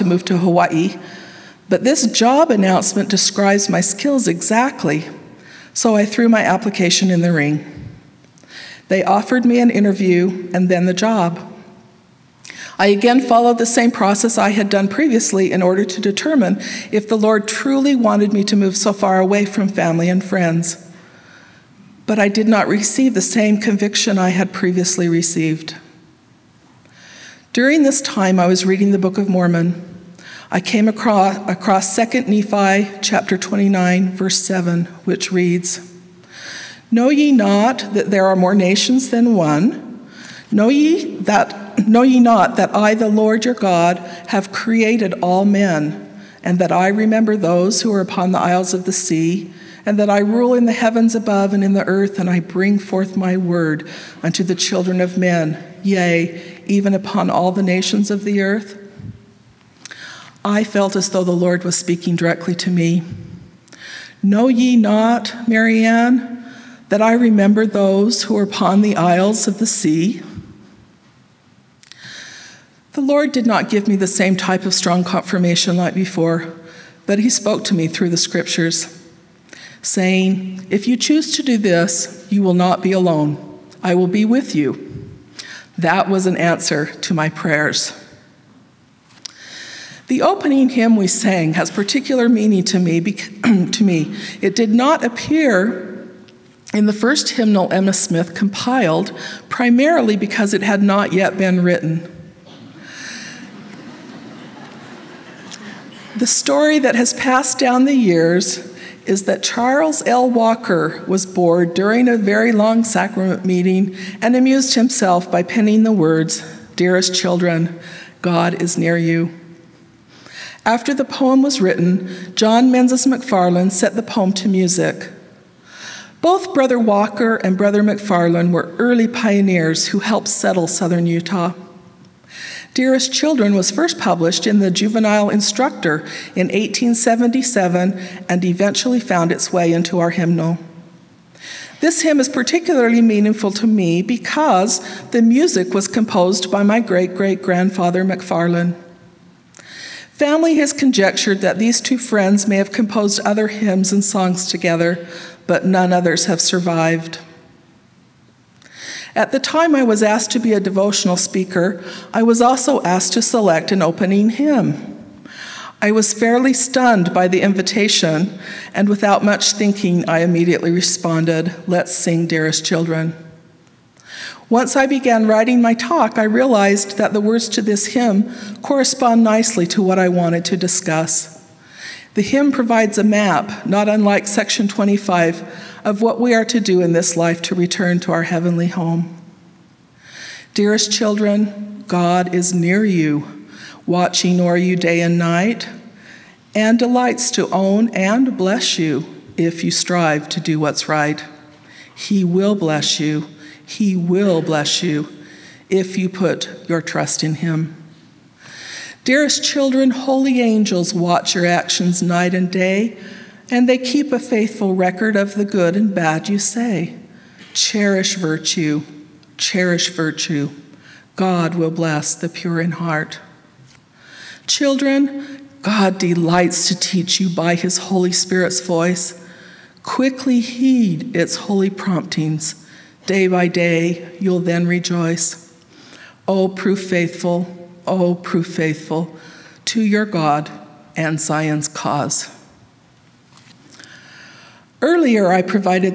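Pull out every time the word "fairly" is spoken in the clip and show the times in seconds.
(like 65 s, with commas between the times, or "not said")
166 s.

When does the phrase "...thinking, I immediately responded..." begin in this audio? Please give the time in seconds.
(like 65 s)
169 s.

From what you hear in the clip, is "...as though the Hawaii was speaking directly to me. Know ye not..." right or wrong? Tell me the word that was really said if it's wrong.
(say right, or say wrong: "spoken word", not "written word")
wrong: "Lord", not "Hawaii".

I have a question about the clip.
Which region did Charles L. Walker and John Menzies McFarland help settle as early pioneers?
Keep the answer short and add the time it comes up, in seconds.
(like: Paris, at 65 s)
southern Utah, at 130 s.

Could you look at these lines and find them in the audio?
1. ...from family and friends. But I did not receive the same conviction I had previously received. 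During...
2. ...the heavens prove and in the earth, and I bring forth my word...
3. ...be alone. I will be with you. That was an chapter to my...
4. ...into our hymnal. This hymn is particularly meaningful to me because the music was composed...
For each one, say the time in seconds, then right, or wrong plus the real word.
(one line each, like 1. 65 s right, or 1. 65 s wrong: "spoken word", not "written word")
1. 19 s right
2. 50 s wrong: "above", not "prove"
3. 82 s wrong: "answer", not "chapter"
4. 139 s right.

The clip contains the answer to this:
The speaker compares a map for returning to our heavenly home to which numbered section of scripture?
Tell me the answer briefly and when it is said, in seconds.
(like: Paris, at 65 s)
section 25, at 184 s.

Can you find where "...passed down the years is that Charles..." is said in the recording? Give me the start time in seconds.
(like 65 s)
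107 s.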